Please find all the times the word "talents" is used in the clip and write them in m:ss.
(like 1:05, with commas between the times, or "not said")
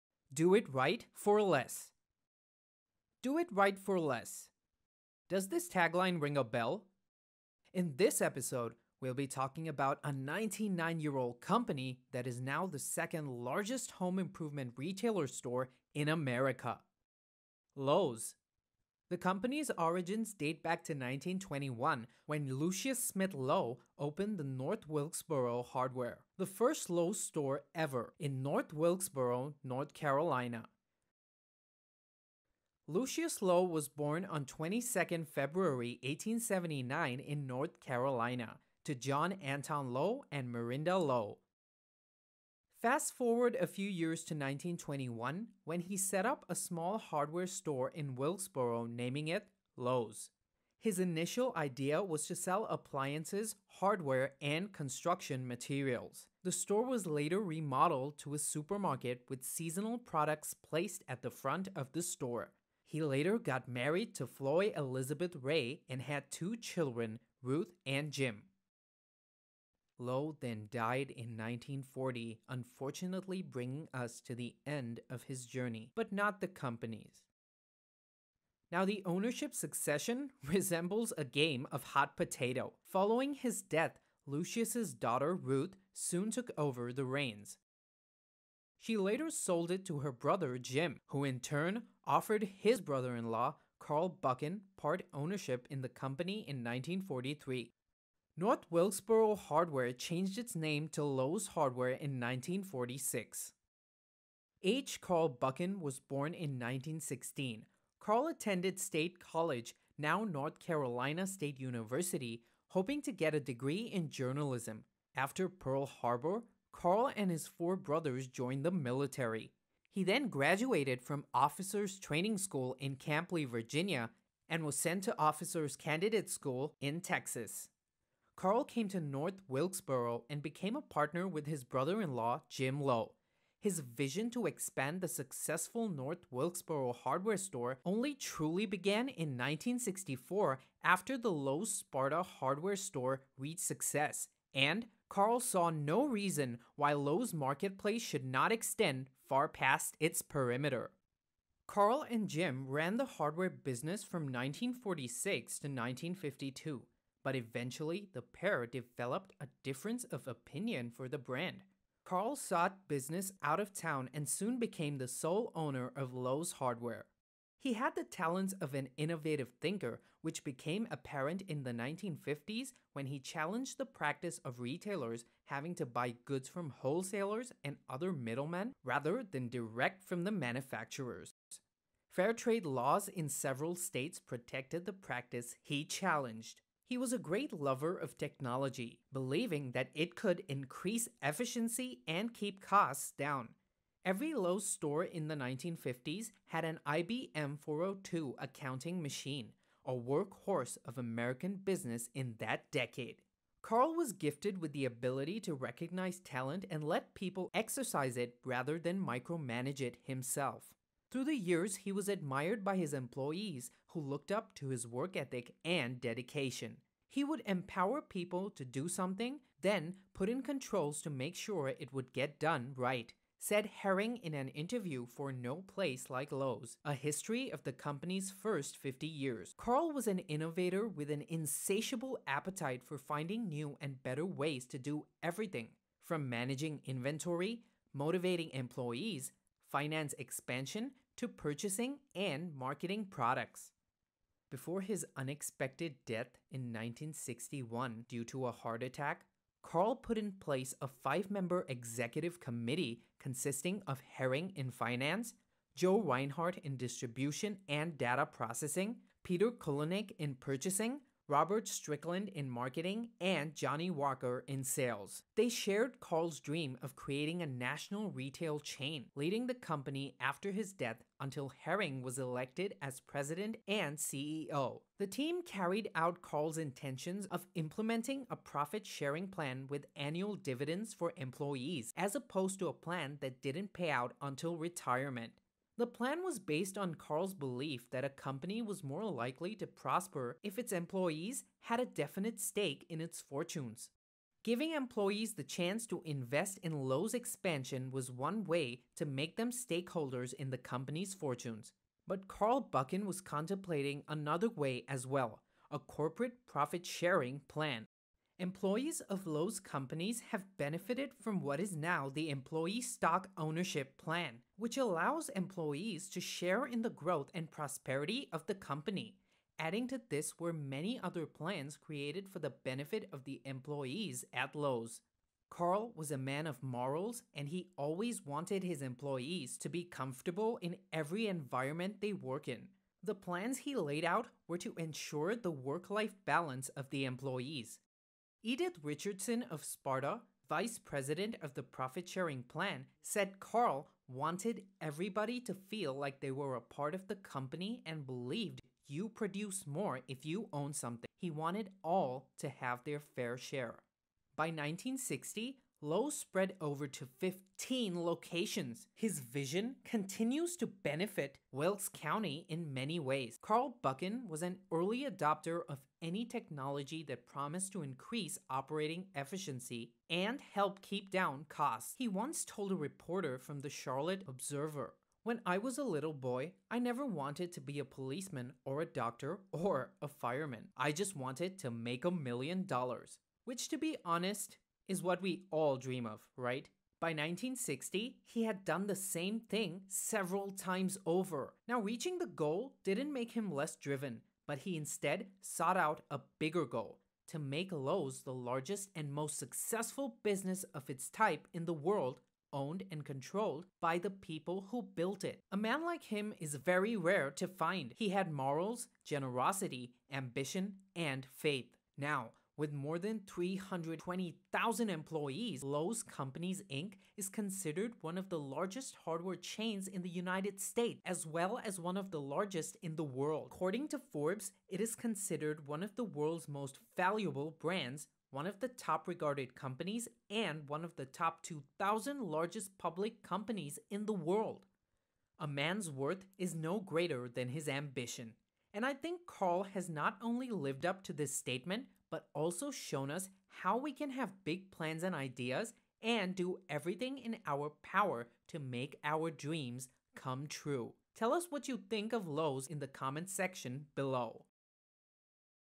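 2:48, 3:26.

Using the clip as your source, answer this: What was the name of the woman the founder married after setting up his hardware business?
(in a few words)
Floy Elizabeth Ray.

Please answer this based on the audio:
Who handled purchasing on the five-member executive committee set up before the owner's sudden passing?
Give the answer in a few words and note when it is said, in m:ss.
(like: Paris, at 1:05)
Peter Kulynych, at 4:19.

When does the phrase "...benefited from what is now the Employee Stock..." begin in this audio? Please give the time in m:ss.
5:10.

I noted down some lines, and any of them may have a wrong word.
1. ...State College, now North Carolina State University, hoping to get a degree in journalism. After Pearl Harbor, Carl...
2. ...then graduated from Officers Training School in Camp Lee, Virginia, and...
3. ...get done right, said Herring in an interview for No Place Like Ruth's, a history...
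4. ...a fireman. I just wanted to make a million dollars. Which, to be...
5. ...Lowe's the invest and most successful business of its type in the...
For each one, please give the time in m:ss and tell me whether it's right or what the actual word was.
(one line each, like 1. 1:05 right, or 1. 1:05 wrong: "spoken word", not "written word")
1. 1:48 right
2. 2:00 right
3. 3:42 wrong: "Lowe", not "Ruth"
4. 6:19 right
5. 6:37 wrong: "largest", not "invest".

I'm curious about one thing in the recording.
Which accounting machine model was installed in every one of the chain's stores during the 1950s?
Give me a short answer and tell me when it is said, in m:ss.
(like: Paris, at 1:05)
IBM 402, at 3:16.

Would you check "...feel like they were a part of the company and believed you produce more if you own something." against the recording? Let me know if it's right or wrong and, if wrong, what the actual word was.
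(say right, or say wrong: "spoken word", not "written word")
right.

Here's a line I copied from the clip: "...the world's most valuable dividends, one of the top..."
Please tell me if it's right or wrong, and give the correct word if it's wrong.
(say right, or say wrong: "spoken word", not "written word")
wrong: "brands", not "dividends".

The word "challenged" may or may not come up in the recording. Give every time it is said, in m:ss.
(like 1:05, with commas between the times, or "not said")
2:53, 3:05.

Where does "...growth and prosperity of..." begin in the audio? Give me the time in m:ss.
5:16.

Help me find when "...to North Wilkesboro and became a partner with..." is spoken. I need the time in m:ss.
2:08.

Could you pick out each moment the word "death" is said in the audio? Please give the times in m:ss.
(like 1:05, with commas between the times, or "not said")
1:23, 4:06, 4:30.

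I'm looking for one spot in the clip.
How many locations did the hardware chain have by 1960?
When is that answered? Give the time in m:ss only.
5:57.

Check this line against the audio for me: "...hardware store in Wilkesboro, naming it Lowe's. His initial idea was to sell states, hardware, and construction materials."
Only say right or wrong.
wrong.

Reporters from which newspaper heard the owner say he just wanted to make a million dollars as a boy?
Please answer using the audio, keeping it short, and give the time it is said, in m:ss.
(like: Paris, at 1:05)
Charlotte Observer, at 6:13.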